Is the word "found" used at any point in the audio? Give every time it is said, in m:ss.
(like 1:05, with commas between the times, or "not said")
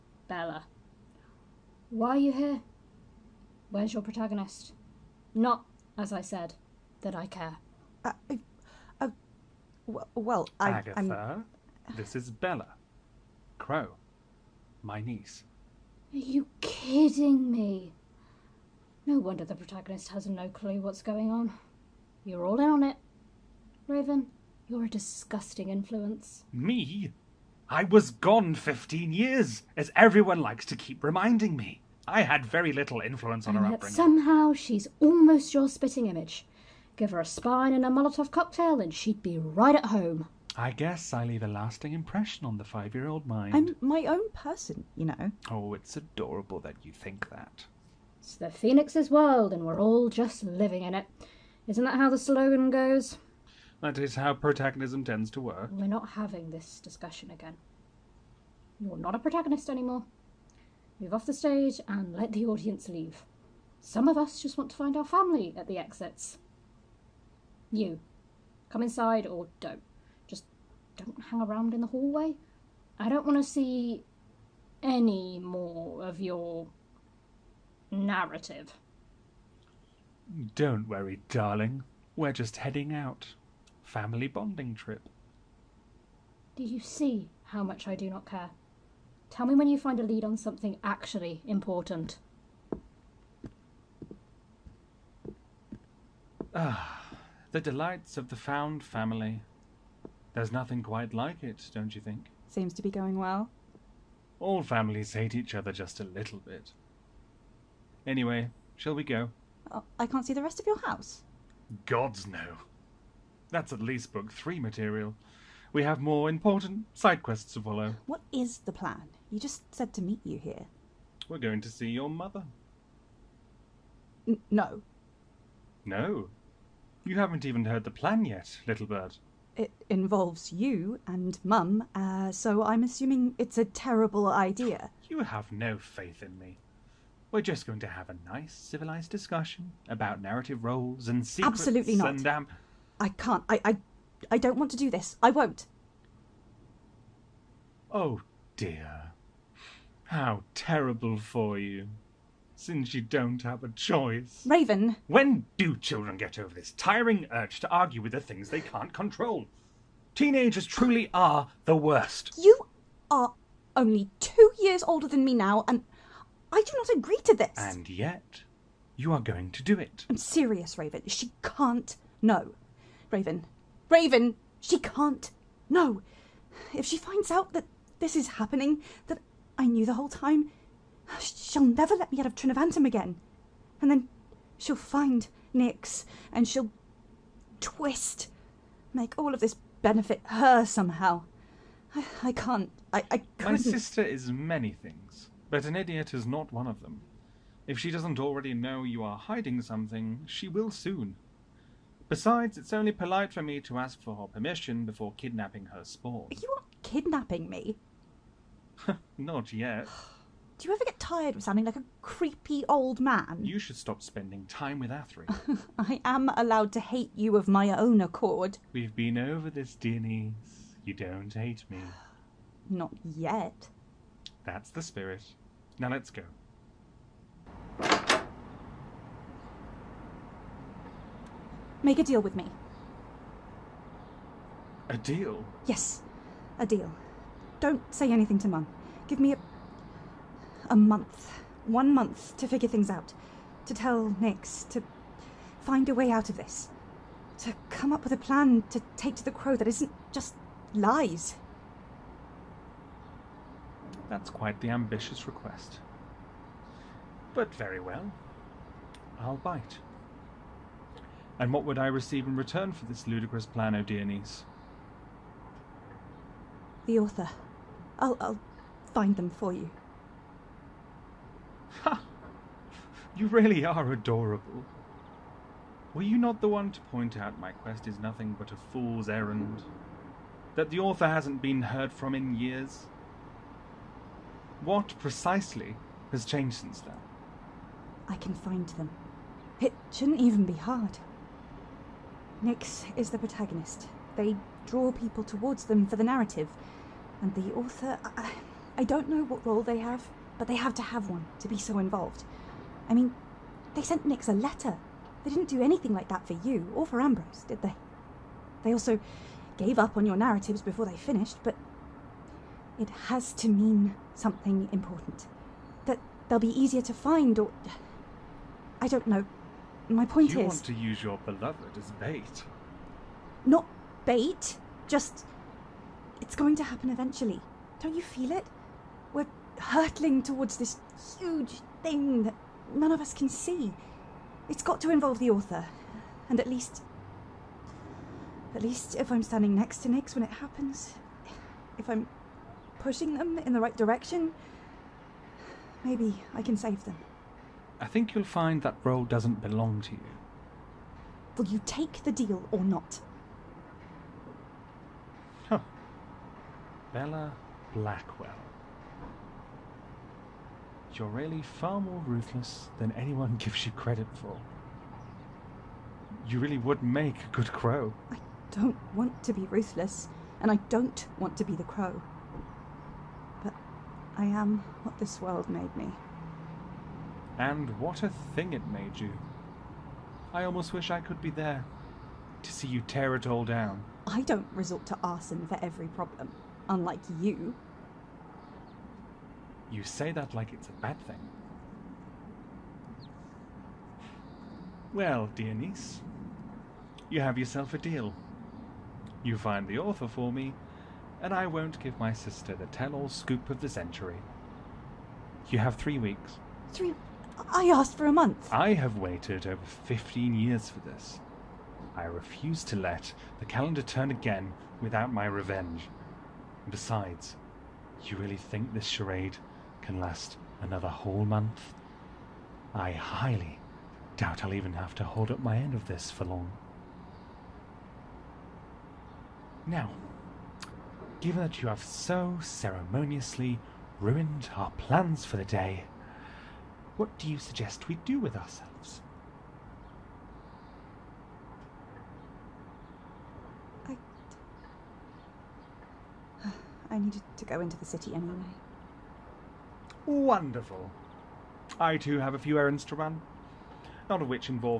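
1:38.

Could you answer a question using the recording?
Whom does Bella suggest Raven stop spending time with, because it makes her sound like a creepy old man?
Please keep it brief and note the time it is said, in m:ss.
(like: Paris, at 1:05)
Athri, at 3:34.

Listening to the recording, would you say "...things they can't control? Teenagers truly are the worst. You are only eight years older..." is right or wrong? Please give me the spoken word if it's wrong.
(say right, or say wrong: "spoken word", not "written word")
wrong: "two", not "eight".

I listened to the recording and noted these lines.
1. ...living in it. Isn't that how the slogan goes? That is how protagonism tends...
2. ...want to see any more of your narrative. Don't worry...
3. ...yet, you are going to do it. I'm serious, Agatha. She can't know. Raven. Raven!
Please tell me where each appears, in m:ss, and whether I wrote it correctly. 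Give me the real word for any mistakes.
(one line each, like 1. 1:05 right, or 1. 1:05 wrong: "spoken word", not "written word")
1. 0:50 right
2. 1:13 right
3. 2:47 wrong: "Raven", not "Agatha".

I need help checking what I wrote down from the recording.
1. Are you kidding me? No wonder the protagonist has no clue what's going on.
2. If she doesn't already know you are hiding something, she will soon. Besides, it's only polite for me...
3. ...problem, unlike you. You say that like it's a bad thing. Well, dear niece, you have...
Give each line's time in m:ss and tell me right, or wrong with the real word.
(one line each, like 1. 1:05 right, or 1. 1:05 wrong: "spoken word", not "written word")
1. 0:16 right
2. 3:17 right
3. 6:25 right.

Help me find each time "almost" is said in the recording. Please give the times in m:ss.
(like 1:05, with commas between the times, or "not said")
0:34, 6:20.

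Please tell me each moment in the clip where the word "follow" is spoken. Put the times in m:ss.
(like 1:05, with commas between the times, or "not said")
1:57.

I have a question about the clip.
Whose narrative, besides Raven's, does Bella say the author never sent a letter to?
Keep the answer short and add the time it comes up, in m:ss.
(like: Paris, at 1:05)
Ambrose, at 5:06.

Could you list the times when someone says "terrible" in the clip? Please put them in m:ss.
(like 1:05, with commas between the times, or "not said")
2:13, 2:30.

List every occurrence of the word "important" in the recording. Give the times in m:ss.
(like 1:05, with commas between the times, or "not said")
1:31, 1:56, 5:14.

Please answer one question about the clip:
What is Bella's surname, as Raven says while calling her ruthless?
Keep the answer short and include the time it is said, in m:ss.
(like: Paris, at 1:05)
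Blackwell, at 5:57.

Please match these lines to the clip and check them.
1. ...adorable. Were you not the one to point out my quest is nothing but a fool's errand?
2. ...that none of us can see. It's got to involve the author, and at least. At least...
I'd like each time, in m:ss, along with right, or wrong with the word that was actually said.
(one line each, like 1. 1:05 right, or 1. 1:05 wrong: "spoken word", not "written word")
1. 4:33 right
2. 5:32 right.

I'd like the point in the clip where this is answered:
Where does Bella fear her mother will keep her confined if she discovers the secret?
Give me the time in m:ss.
3:02.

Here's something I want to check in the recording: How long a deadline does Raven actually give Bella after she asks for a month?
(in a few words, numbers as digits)
3 weeks.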